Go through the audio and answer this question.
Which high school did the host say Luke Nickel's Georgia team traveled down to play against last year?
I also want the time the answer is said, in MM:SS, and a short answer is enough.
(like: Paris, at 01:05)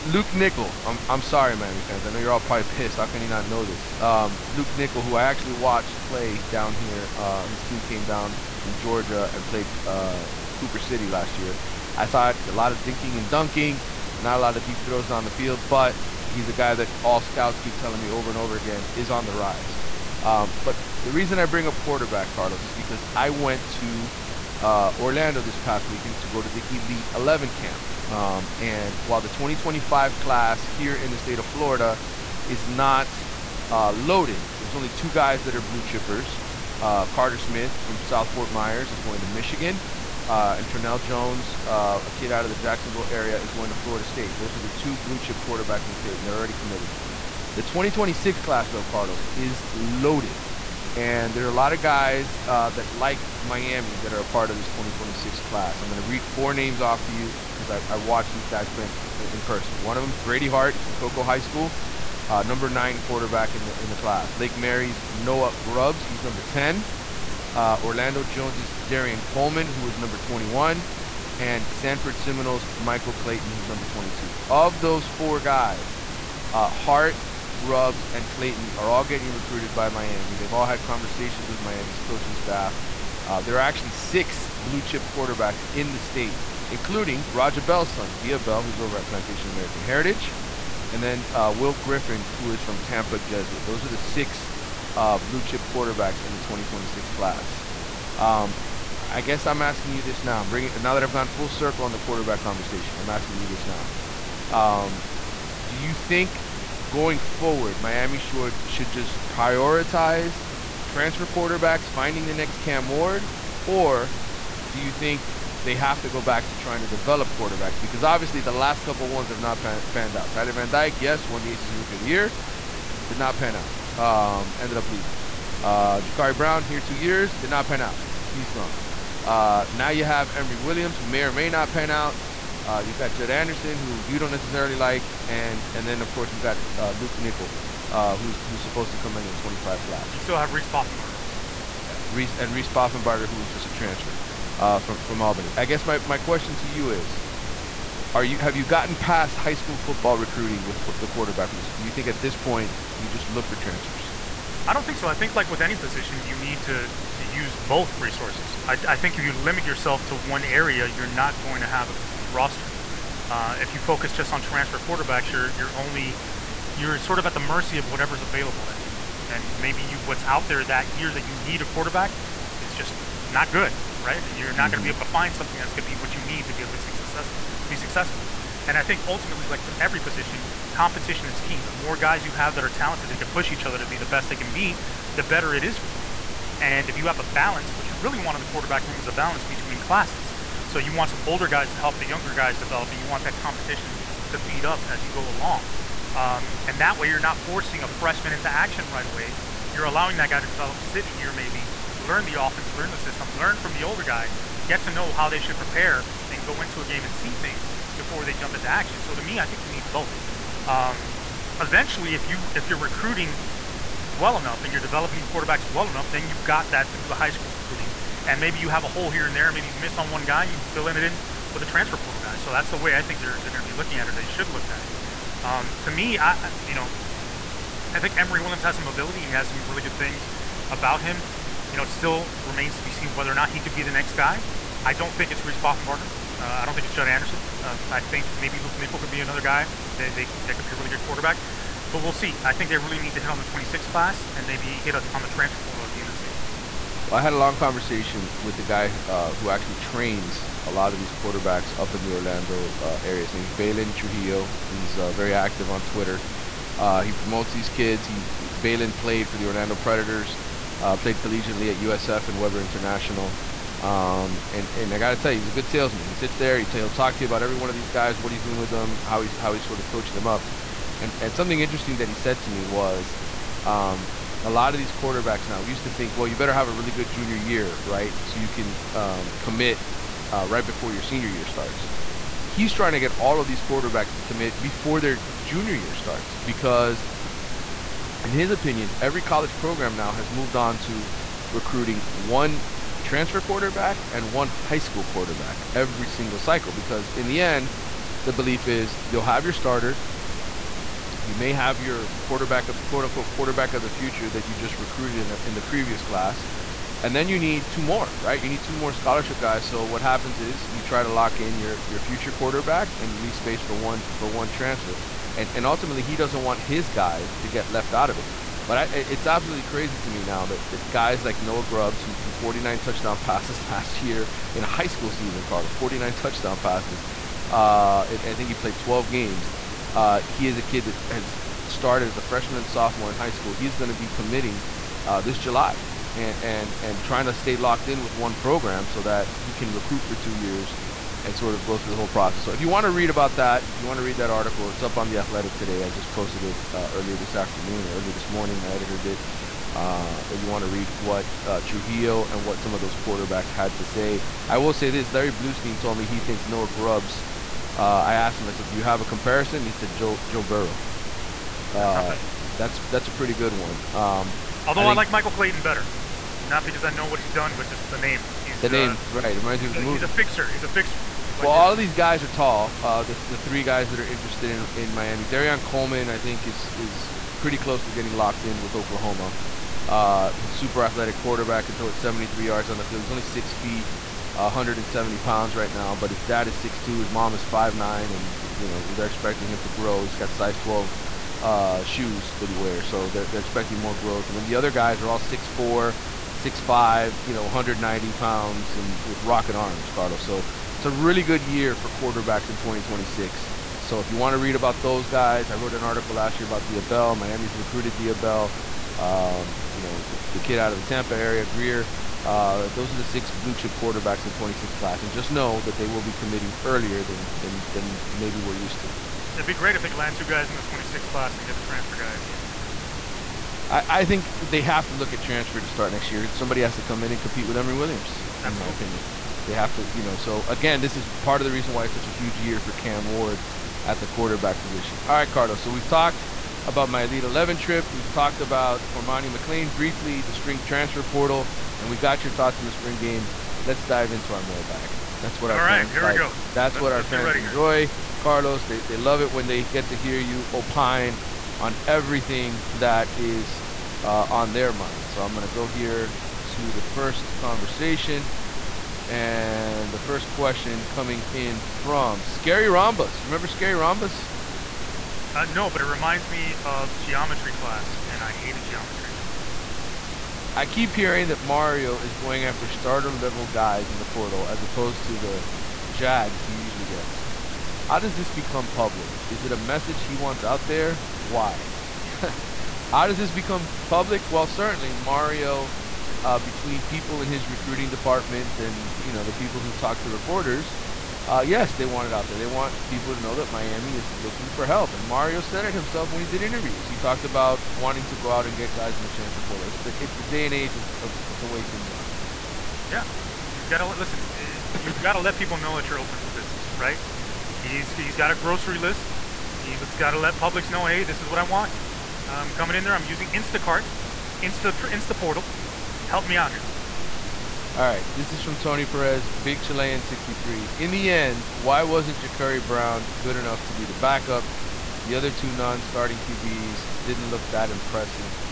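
Cooper City, at 00:10.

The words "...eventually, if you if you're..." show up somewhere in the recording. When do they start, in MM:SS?
03:31.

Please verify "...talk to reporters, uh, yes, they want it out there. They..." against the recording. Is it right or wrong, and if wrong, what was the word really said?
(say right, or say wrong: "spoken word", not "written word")
right.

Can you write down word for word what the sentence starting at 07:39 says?
And the first question coming in from Scary Rhombus.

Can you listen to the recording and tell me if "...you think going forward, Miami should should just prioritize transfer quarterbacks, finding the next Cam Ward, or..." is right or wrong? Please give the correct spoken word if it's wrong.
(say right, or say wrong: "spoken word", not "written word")
right.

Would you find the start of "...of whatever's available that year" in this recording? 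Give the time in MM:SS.
02:47.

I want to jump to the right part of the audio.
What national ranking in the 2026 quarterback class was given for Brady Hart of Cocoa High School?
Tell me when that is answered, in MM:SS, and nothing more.
01:02.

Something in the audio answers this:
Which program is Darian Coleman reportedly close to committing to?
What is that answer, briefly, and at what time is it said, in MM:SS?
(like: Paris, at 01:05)
Oklahoma, at 06:18.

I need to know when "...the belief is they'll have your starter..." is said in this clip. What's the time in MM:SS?
04:58.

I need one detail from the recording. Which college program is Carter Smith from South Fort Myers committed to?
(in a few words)
Michigan.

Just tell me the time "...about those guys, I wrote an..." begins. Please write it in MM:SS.
06:44.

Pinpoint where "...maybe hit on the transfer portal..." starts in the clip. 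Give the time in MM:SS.
04:04.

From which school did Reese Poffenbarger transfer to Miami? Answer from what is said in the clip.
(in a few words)
Albany.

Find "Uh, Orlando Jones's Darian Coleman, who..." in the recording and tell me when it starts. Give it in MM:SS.
01:07.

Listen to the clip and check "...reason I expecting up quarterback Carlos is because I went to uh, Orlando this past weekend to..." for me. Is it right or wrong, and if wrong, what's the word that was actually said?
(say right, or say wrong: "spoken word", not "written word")
wrong: "bring", not "expecting".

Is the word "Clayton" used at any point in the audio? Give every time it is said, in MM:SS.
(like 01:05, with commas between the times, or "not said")
01:13, 01:18, 06:05.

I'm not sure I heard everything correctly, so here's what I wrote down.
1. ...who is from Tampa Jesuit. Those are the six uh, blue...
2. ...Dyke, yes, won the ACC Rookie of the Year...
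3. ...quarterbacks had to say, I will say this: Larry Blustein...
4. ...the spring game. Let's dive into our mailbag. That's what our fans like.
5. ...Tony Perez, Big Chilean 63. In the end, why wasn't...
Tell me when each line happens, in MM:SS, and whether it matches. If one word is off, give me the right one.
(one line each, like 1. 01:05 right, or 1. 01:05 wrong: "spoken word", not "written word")
1. 01:32 right
2. 02:00 right
3. 05:52 right
4. 07:22 right
5. 08:38 right.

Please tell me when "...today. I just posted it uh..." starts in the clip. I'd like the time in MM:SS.
05:45.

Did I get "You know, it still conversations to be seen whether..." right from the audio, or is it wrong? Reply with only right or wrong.
wrong.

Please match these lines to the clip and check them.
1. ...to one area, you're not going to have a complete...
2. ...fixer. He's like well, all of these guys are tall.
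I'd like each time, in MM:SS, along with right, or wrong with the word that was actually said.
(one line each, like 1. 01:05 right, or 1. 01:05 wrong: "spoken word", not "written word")
1. 02:40 right
2. 06:10 right.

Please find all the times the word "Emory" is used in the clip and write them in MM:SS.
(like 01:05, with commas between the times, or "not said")
02:10, 03:48, 07:07.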